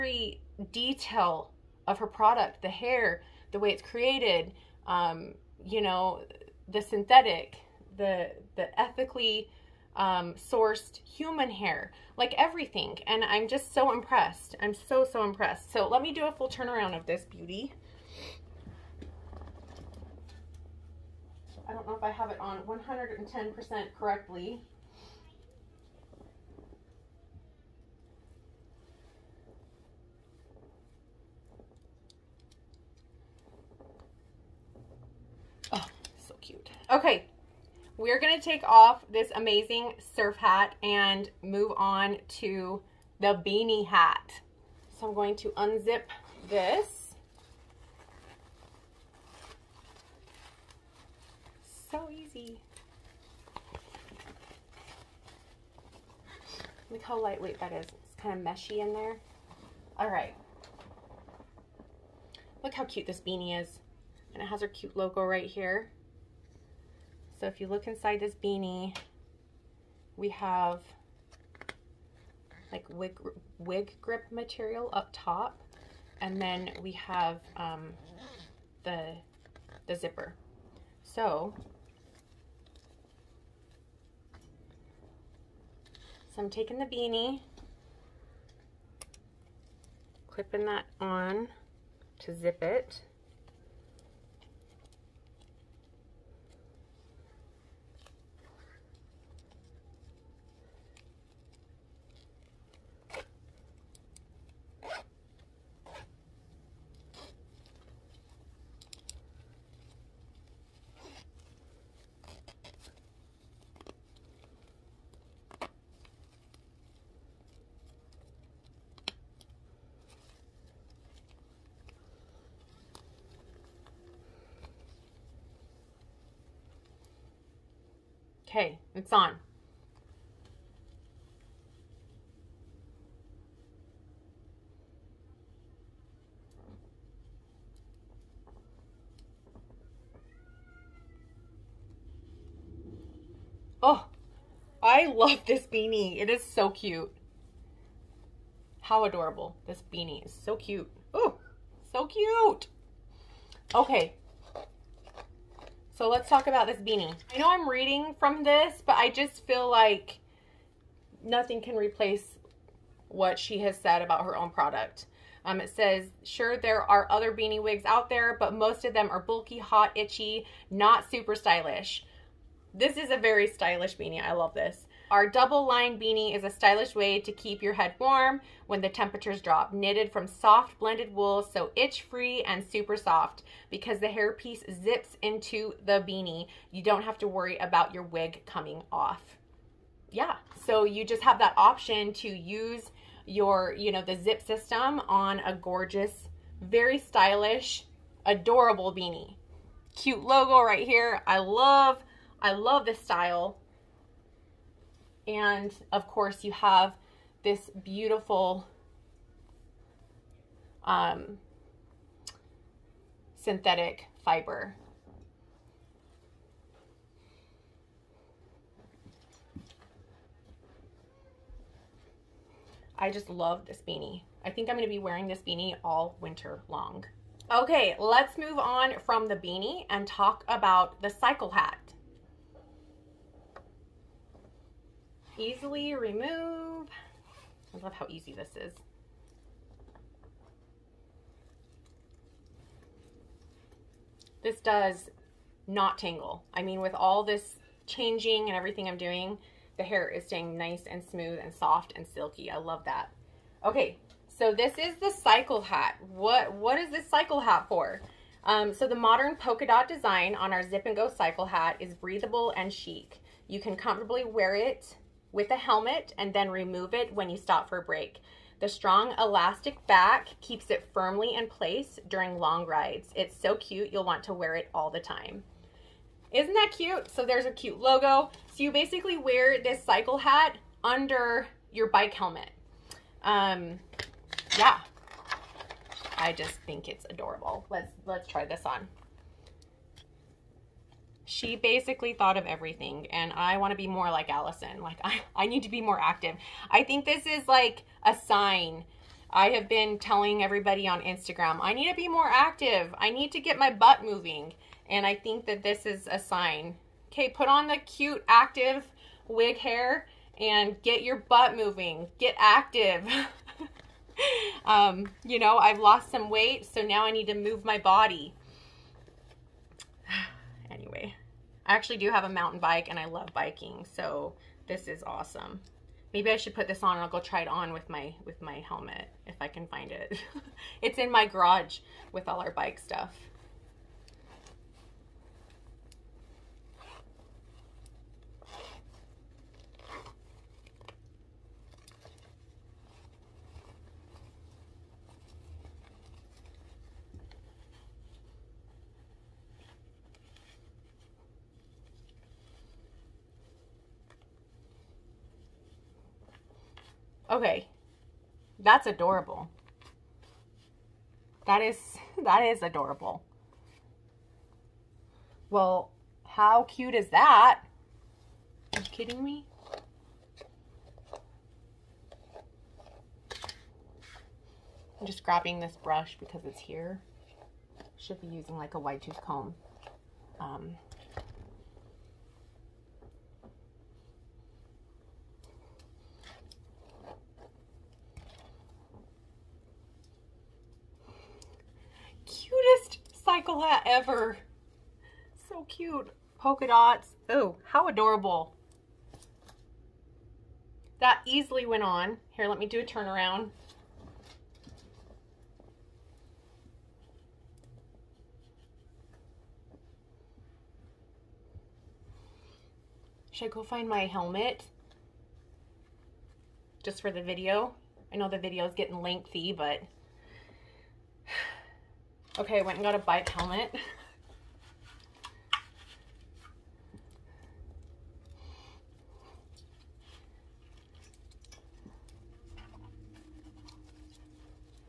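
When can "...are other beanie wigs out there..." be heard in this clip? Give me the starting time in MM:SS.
02:46.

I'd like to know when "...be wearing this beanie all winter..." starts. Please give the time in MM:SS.
03:44.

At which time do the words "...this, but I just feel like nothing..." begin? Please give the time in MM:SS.
02:38.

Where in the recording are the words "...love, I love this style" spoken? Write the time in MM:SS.
03:21.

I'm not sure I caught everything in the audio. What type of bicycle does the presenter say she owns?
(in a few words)
Mountain bike.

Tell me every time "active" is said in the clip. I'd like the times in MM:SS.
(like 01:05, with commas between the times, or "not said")
04:55, 05:02, 05:08, 05:12.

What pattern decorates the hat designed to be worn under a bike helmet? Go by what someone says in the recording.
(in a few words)
Polka dot.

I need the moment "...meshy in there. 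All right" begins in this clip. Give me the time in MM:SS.
00:58.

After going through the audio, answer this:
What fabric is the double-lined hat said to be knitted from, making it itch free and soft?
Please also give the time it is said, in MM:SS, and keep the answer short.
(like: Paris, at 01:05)
Soft blended wool, at 03:00.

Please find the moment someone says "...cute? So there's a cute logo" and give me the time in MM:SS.
04:36.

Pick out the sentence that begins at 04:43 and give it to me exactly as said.
Um, yeah, I just think it's adorable.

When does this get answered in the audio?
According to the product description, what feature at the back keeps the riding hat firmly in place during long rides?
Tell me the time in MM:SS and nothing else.
04:28.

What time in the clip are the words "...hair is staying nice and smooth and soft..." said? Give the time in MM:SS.
04:09.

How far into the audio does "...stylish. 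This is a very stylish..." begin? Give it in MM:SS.
02:51.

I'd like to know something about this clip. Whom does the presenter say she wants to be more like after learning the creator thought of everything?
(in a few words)
Allison.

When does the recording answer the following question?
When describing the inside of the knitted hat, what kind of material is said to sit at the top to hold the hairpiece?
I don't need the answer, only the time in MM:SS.
01:13.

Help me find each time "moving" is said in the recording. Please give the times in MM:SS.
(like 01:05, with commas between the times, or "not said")
05:04, 05:11.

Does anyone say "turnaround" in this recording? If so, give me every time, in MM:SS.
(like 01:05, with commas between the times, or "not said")
00:16, 06:42.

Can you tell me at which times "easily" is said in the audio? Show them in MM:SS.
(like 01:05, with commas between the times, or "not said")
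03:55, 06:41.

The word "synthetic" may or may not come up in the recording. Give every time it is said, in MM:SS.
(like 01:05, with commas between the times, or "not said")
00:06, 03:33.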